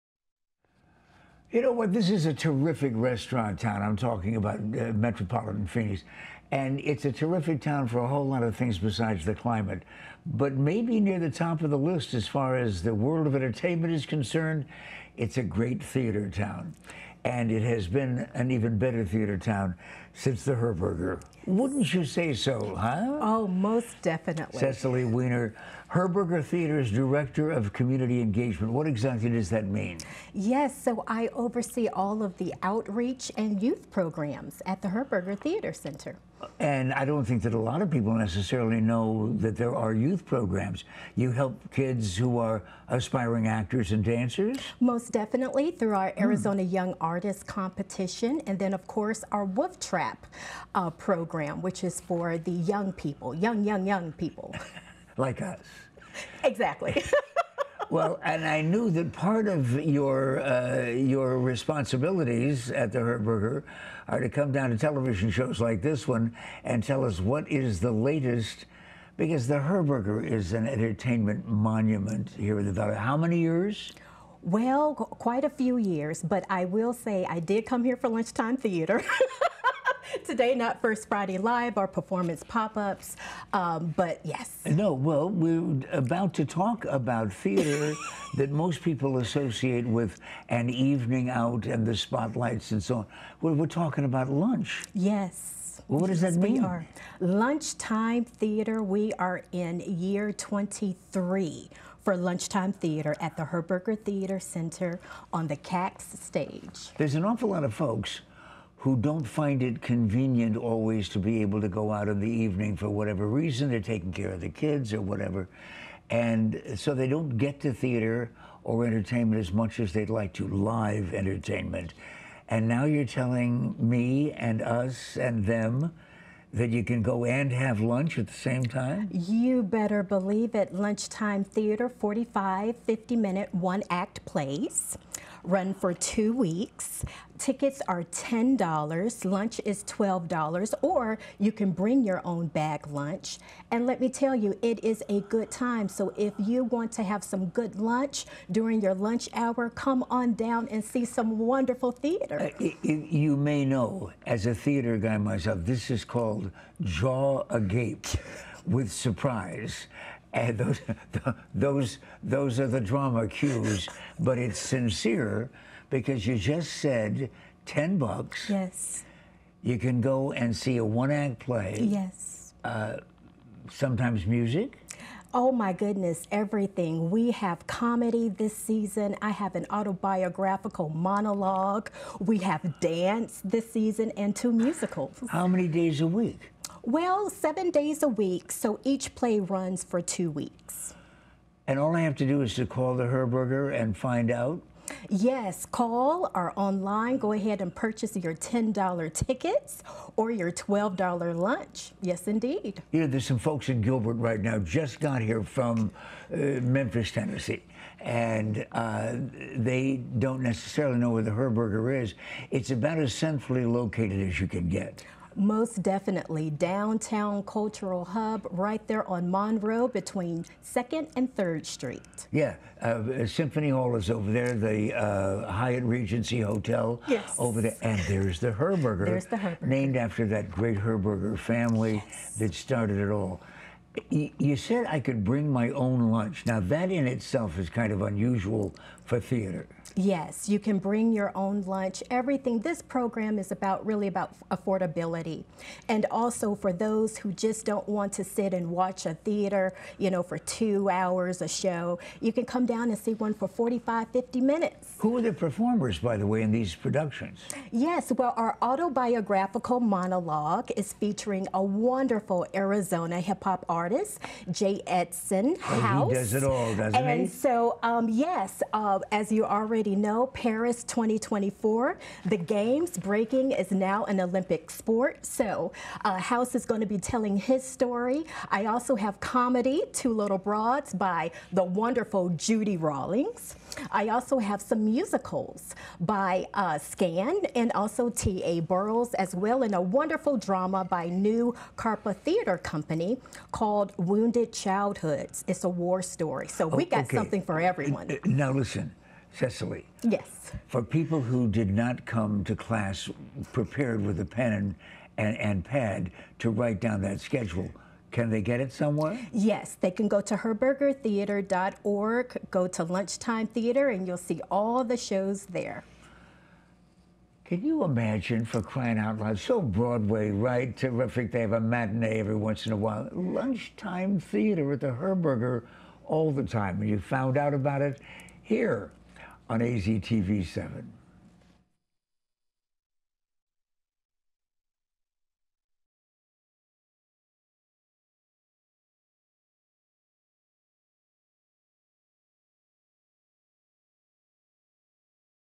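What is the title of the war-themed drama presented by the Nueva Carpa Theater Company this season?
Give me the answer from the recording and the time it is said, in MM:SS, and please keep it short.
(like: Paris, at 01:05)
Wounded Childhoods, at 04:53.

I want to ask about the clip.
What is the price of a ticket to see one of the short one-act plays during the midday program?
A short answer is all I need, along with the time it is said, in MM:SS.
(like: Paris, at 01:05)
$10, at 02:17.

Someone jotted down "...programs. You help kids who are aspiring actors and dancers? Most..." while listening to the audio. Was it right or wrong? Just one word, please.
right.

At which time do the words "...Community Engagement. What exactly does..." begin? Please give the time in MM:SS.
00:27.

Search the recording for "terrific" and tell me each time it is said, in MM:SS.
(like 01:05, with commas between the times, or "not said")
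00:02, 00:07, 05:20.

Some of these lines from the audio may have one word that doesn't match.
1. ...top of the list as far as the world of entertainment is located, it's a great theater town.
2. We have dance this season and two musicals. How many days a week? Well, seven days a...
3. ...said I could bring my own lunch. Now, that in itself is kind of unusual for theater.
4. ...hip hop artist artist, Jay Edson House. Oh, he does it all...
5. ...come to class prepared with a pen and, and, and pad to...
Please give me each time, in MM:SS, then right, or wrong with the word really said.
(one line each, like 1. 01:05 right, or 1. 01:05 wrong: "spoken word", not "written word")
1. 00:11 wrong: "concerned", not "located"
2. 03:02 right
3. 03:54 right
4. 04:23 right
5. 05:02 right.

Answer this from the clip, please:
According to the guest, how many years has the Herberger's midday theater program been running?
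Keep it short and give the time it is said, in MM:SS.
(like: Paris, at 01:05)
23, at 01:39.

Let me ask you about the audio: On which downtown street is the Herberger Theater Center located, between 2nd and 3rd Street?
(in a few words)
Monroe.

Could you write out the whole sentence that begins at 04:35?
So uh, House is going to be telling his story.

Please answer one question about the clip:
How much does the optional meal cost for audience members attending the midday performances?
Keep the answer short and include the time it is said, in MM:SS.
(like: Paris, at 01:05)
$12, at 02:19.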